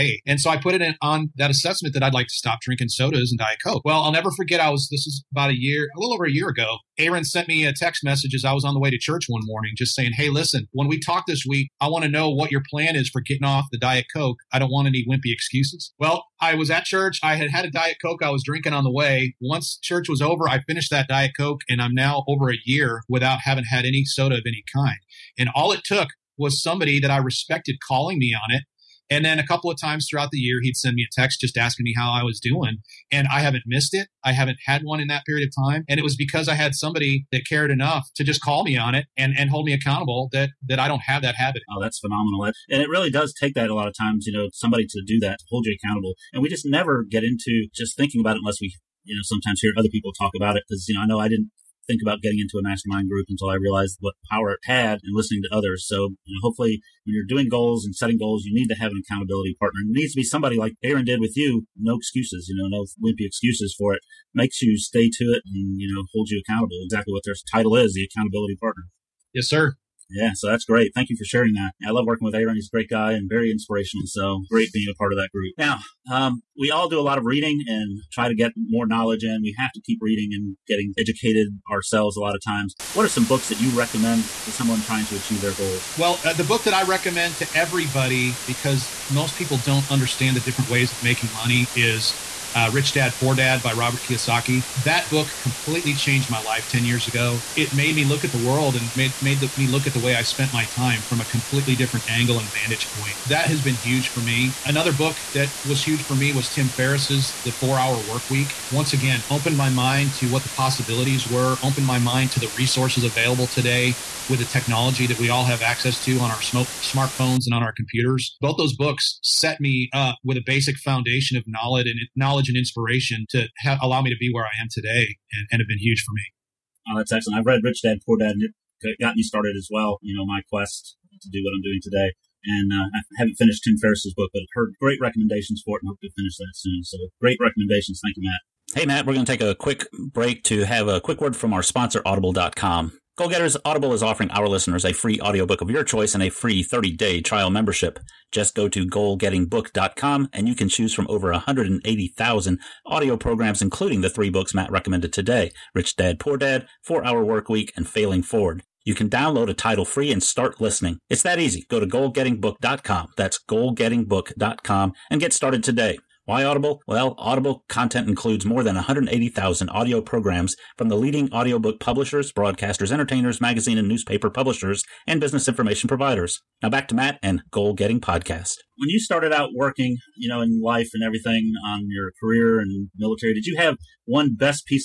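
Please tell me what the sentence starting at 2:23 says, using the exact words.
Goal Getters Audible is offering our listeners a free audiobook of your choice and a free 30 day trial membership.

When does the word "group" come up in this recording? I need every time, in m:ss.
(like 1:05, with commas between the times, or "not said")
0:53, 1:15.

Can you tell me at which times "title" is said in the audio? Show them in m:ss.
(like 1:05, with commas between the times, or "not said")
1:07, 2:39.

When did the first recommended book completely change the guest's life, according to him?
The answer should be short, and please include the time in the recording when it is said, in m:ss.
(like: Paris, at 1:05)
10 years ago, at 1:36.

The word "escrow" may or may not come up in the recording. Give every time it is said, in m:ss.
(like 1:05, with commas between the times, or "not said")
not said.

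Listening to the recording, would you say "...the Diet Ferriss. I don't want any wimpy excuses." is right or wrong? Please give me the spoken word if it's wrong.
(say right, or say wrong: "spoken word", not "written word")
wrong: "Coke", not "Ferriss".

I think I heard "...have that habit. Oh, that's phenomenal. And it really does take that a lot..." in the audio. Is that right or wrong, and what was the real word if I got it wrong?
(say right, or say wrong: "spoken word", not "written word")
right.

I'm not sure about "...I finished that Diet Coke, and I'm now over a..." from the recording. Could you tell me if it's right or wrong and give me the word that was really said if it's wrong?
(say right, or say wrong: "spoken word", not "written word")
right.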